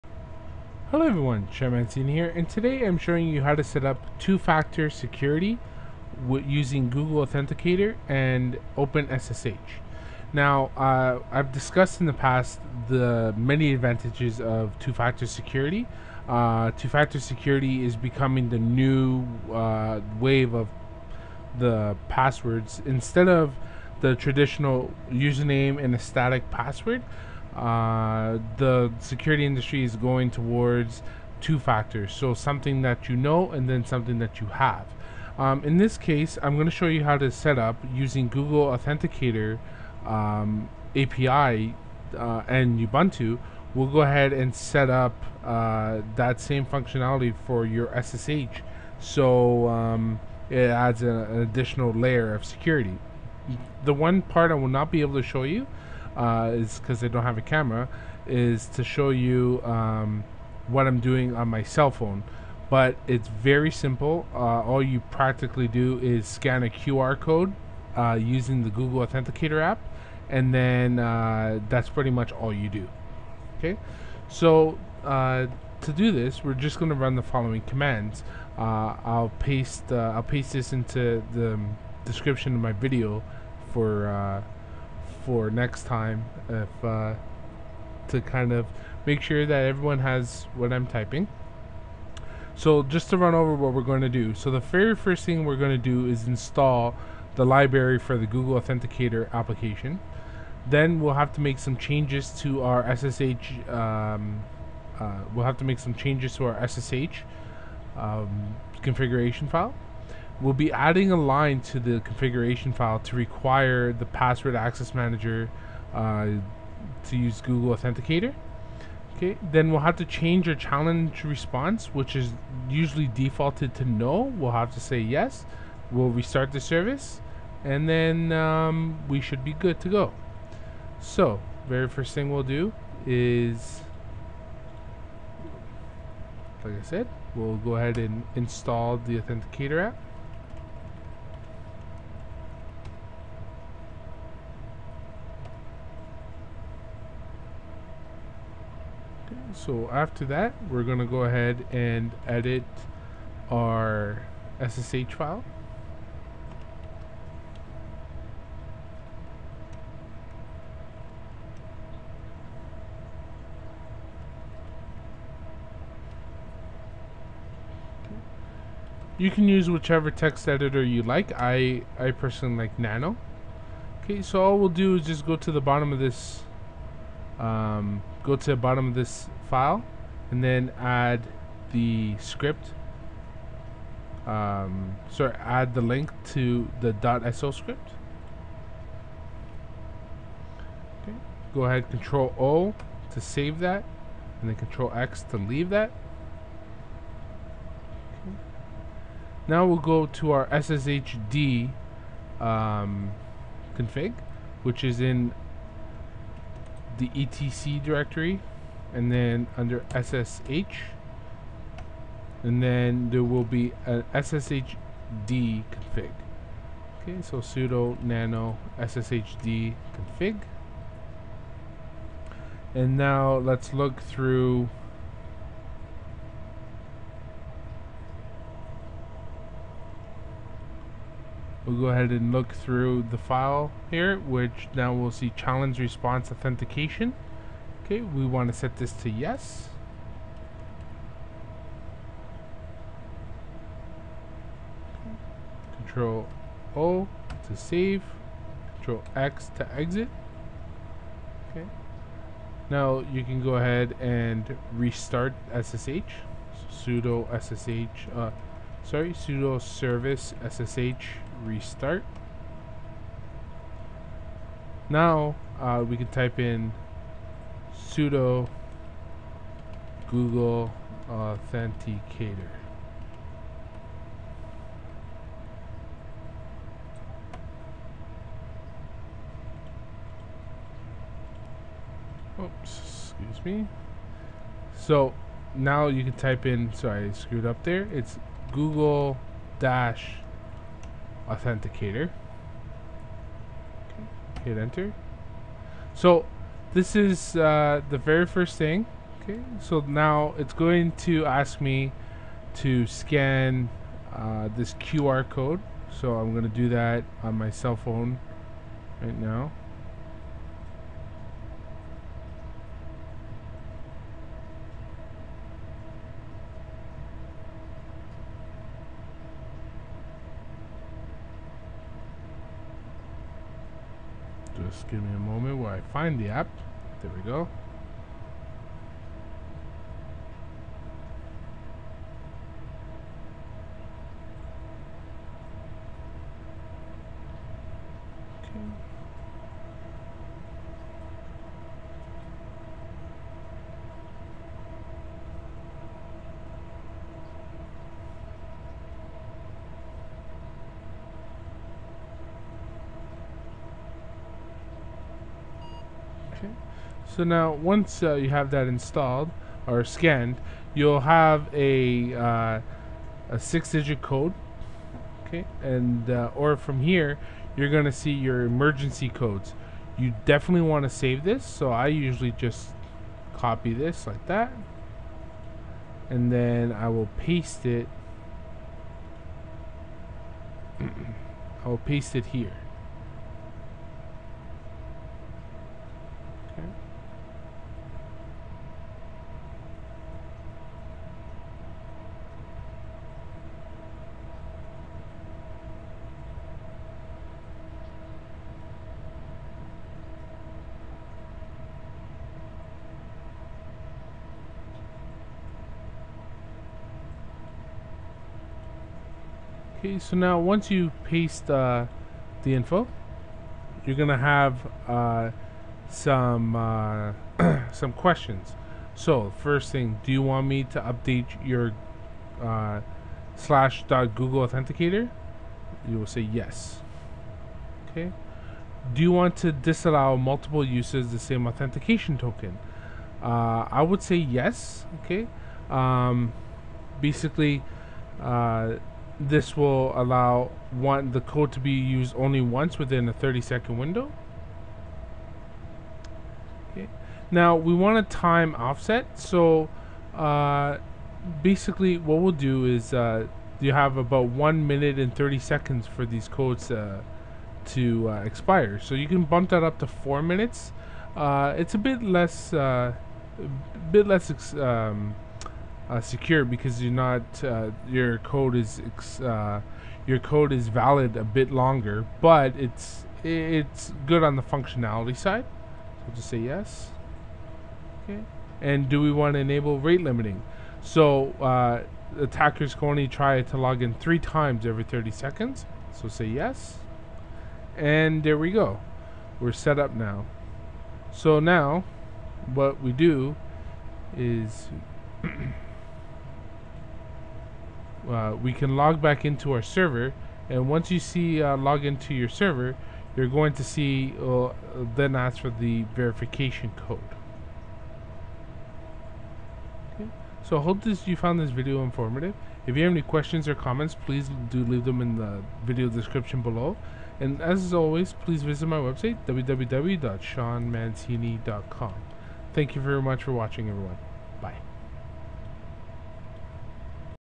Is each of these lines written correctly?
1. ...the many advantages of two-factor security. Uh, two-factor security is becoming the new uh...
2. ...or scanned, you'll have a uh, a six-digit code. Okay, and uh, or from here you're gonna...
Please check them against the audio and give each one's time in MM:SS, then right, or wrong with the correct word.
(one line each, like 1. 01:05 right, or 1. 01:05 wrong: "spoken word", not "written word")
1. 00:12 right
2. 05:59 right.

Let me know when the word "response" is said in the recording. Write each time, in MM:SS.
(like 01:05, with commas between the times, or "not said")
02:01, 03:55.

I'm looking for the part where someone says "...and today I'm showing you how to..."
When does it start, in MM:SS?
00:02.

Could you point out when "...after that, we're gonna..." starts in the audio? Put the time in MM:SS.
02:29.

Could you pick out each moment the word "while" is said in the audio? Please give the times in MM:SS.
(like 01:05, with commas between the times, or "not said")
05:25.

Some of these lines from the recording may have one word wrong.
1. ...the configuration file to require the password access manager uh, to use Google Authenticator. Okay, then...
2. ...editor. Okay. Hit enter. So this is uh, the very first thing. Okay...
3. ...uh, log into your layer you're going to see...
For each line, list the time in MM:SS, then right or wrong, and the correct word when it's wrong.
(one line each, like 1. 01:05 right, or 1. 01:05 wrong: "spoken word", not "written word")
1. 01:51 right
2. 04:51 wrong: "authenticator", not "editor"
3. 08:21 wrong: "server", not "layer".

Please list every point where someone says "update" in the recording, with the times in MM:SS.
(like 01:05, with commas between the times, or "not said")
07:00.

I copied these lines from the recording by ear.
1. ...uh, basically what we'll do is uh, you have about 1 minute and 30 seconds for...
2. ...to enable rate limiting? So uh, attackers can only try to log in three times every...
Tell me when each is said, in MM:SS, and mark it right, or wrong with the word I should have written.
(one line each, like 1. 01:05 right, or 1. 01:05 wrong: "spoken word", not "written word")
1. 07:30 right
2. 07:59 right.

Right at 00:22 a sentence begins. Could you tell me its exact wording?
Instead of the traditional username and a static password, uh, the security industry is going towards two factors.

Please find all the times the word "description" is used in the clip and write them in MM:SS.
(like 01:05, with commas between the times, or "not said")
01:22, 08:35.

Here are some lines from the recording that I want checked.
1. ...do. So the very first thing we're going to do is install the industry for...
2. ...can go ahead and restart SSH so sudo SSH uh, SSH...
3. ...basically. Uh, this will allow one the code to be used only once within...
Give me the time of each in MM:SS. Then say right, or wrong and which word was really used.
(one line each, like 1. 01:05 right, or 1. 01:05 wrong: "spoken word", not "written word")
1. 01:34 wrong: "library", not "industry"
2. 04:13 wrong: "Sorry", not "SSH"
3. 07:17 right.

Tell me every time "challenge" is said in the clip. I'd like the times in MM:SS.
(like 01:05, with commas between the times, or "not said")
02:00, 03:55.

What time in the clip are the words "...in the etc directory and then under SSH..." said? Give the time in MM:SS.
03:25.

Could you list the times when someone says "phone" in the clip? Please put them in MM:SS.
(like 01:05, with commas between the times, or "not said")
01:01, 05:07.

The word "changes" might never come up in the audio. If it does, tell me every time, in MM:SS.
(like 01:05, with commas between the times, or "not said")
01:41, 01:45, 02:00.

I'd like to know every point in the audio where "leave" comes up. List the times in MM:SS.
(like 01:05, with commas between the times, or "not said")
03:15, 08:34.